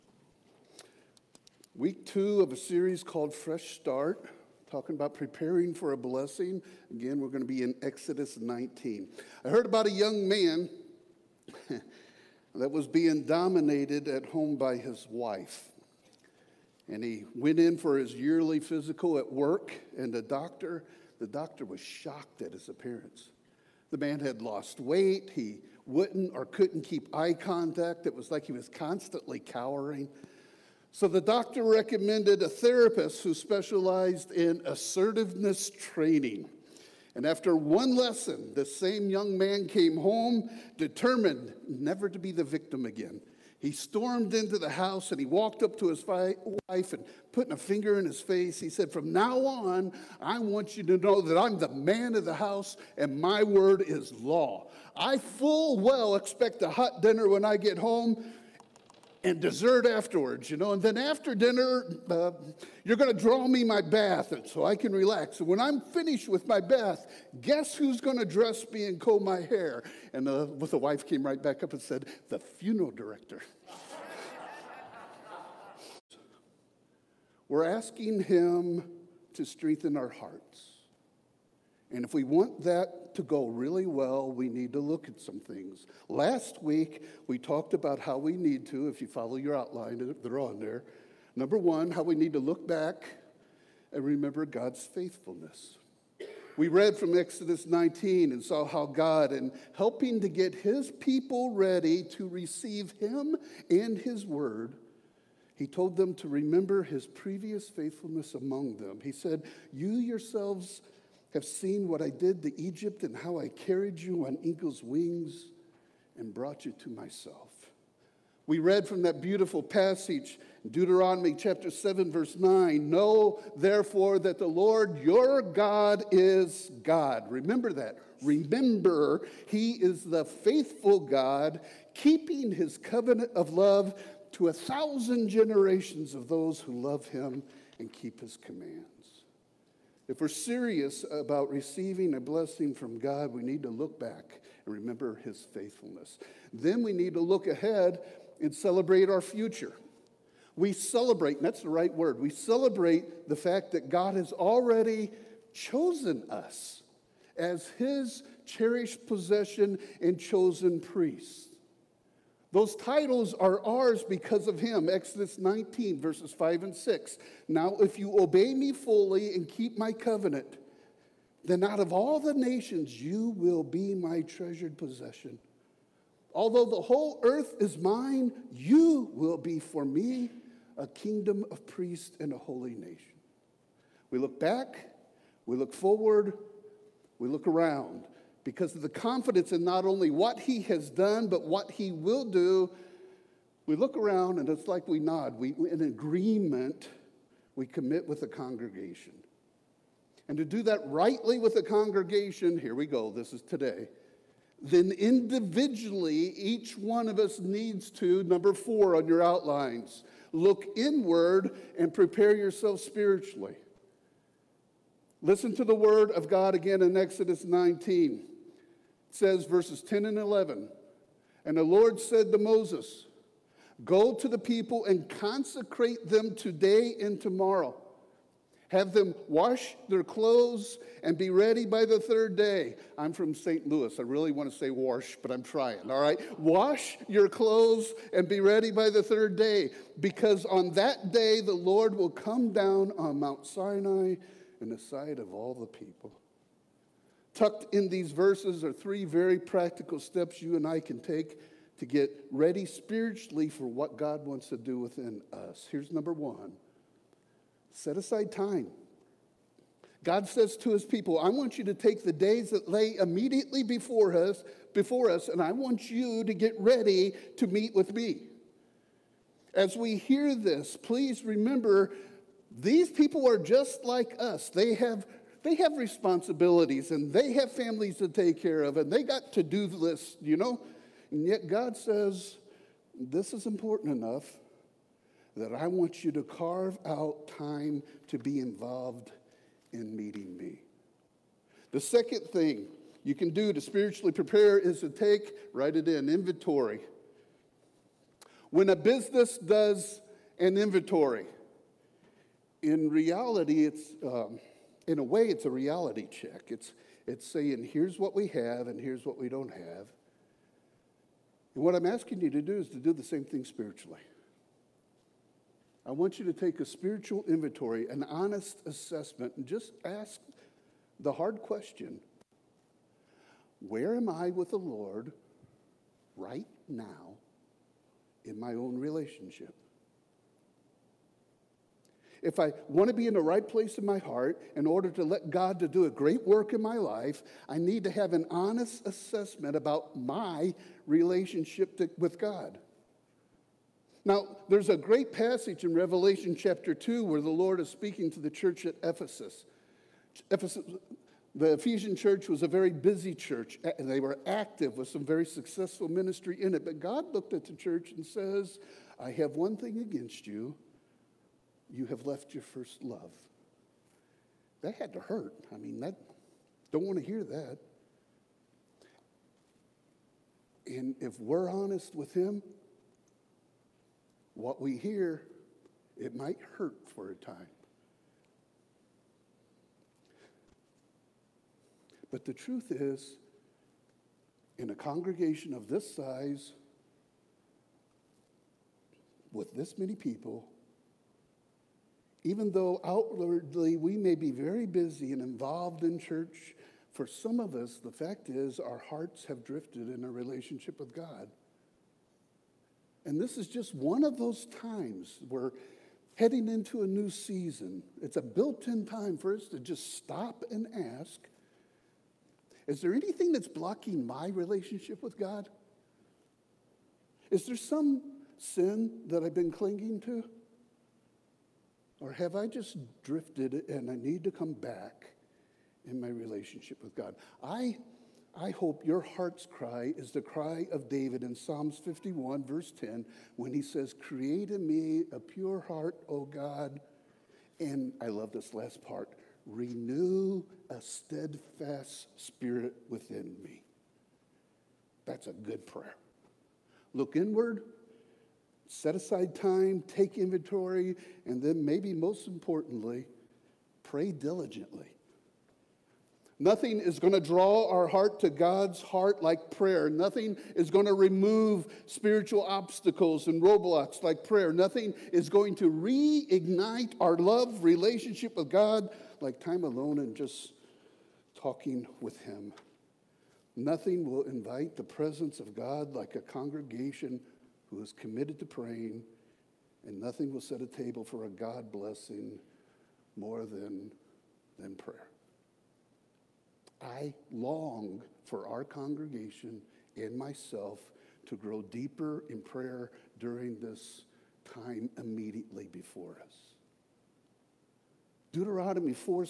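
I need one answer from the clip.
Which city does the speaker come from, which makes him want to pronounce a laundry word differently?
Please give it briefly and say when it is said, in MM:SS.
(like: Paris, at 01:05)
St. Louis, at 03:53.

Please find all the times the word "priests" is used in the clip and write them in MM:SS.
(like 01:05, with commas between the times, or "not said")
02:40, 03:01.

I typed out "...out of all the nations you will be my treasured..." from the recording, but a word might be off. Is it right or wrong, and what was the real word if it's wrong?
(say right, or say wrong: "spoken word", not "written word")
right.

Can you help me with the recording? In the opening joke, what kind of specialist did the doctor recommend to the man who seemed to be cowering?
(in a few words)
A therapist.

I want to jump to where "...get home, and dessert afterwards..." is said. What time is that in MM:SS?
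00:57.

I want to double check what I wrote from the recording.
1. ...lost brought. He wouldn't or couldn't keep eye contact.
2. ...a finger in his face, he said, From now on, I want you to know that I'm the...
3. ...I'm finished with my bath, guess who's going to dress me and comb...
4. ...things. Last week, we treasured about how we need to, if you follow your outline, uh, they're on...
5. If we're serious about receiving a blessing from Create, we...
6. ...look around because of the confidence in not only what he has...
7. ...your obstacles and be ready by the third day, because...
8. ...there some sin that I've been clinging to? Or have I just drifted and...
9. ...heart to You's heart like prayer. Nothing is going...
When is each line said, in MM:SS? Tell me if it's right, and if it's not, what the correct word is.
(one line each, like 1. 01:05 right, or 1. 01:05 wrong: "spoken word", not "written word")
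1. 00:24 wrong: "weight", not "brought"
2. 00:47 right
3. 01:05 right
4. 01:25 wrong: "talked", not "treasured"
5. 02:20 wrong: "God", not "Create"
6. 03:07 right
7. 03:57 wrong: "clothes", not "obstacles"
8. 06:57 right
9. 07:37 wrong: "God", not "You".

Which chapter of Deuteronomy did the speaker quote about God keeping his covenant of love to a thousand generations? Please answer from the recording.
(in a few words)
Chapter 7.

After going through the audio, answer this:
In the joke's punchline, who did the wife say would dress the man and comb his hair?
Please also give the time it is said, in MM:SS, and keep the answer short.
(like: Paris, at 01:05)
The funeral director, at 01:12.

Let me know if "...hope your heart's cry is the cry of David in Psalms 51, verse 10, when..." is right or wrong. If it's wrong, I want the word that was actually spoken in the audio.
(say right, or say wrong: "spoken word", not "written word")
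right.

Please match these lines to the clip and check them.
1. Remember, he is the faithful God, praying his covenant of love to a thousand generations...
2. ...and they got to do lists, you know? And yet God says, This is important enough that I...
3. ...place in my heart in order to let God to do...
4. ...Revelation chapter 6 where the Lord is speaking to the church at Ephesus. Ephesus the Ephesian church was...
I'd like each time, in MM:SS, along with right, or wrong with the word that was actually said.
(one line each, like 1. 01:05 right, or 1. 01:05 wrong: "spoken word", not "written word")
1. 02:08 wrong: "keeping", not "praying"
2. 04:38 right
3. 05:33 right
4. 05:45 wrong: "2", not "6".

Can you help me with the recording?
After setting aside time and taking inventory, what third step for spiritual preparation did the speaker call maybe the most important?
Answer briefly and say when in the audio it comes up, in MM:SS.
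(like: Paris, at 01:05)
Pray diligently, at 07:33.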